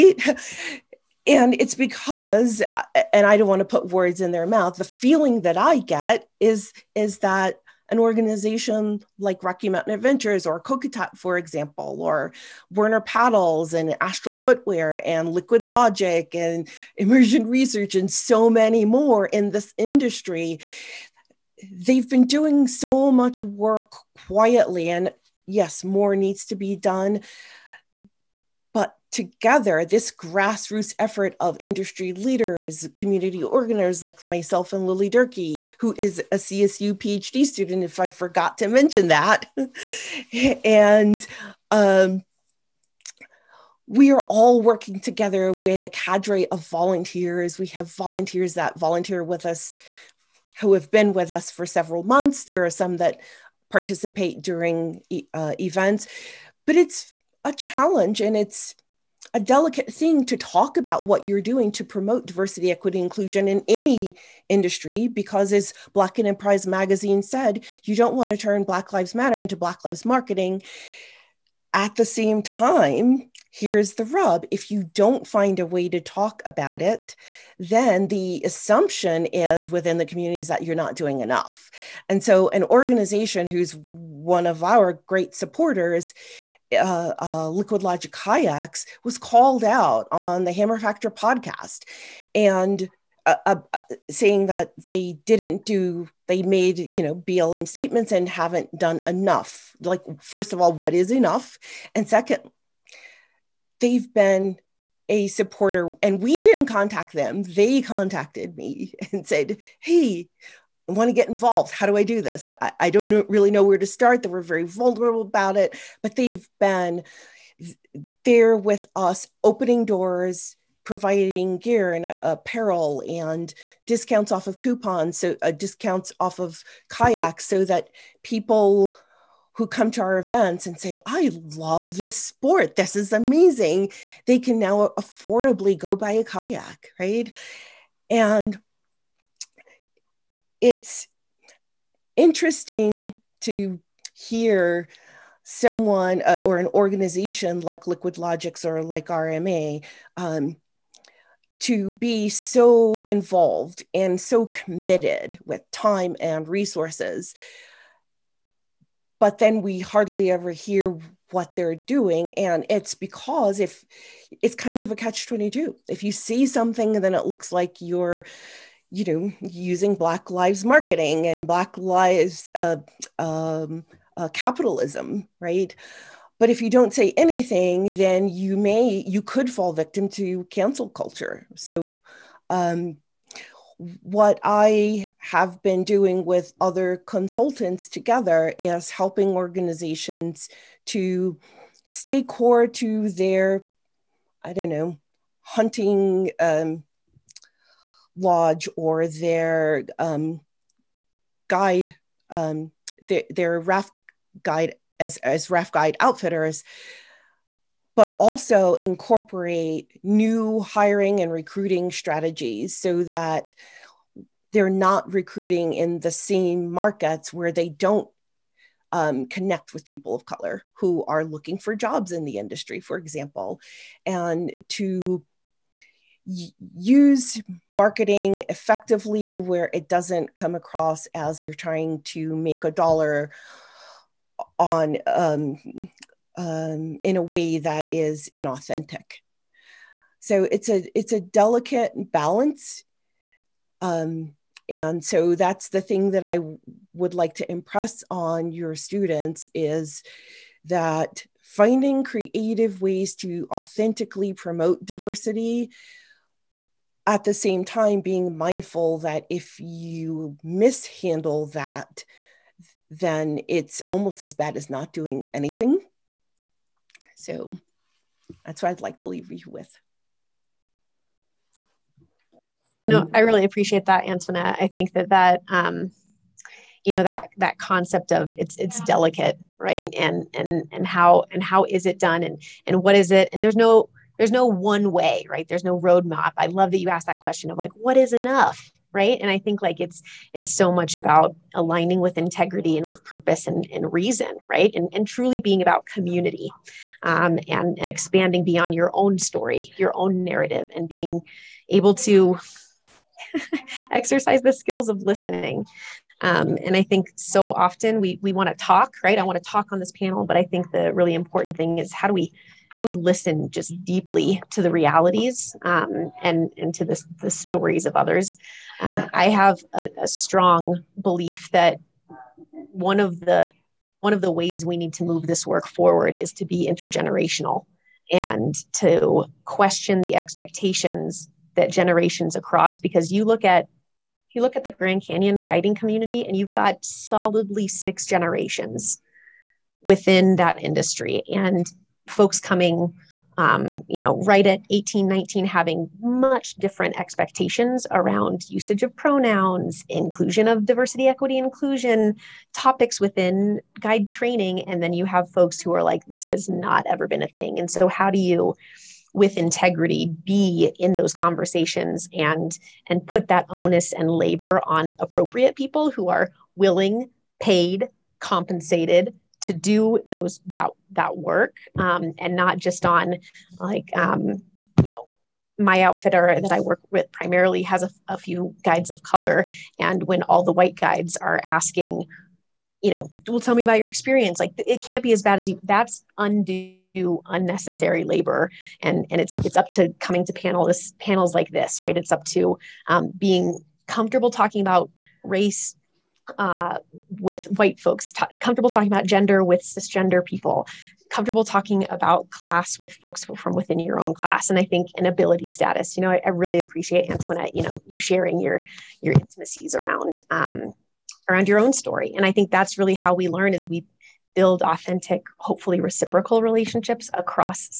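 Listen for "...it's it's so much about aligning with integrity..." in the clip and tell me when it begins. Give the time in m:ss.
4:49.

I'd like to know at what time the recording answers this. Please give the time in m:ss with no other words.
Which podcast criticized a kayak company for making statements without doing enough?
1:30.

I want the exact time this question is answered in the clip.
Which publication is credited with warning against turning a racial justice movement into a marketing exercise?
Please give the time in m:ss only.
1:05.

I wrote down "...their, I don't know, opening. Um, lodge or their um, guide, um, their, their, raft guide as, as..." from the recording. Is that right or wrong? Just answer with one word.
wrong.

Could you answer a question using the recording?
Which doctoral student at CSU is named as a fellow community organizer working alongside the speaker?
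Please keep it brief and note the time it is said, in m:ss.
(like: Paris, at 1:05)
Lily Durkee, at 0:34.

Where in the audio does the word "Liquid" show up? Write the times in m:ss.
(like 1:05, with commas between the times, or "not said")
0:15, 1:27, 2:27.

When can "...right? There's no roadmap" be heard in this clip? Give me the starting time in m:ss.
4:45.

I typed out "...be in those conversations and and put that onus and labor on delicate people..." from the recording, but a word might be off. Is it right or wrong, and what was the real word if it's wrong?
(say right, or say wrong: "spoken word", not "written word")
wrong: "appropriate", not "delicate".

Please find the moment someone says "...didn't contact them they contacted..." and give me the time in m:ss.
1:46.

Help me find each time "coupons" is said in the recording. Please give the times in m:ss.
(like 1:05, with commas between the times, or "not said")
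2:04.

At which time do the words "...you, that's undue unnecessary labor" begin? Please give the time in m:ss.
6:25.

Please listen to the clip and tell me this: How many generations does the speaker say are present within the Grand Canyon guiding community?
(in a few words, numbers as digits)
6.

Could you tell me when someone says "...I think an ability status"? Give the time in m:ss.
6:44.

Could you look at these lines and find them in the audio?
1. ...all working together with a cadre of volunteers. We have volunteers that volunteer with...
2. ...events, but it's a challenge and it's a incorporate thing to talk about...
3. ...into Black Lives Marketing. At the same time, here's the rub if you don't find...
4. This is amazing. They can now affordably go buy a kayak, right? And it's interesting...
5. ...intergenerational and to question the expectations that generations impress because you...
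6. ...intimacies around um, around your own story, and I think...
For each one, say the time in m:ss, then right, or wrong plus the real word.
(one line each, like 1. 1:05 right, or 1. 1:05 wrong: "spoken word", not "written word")
1. 0:44 right
2. 0:55 wrong: "delicate", not "incorporate"
3. 1:09 right
4. 2:12 right
5. 5:26 wrong: "across", not "impress"
6. 6:49 right.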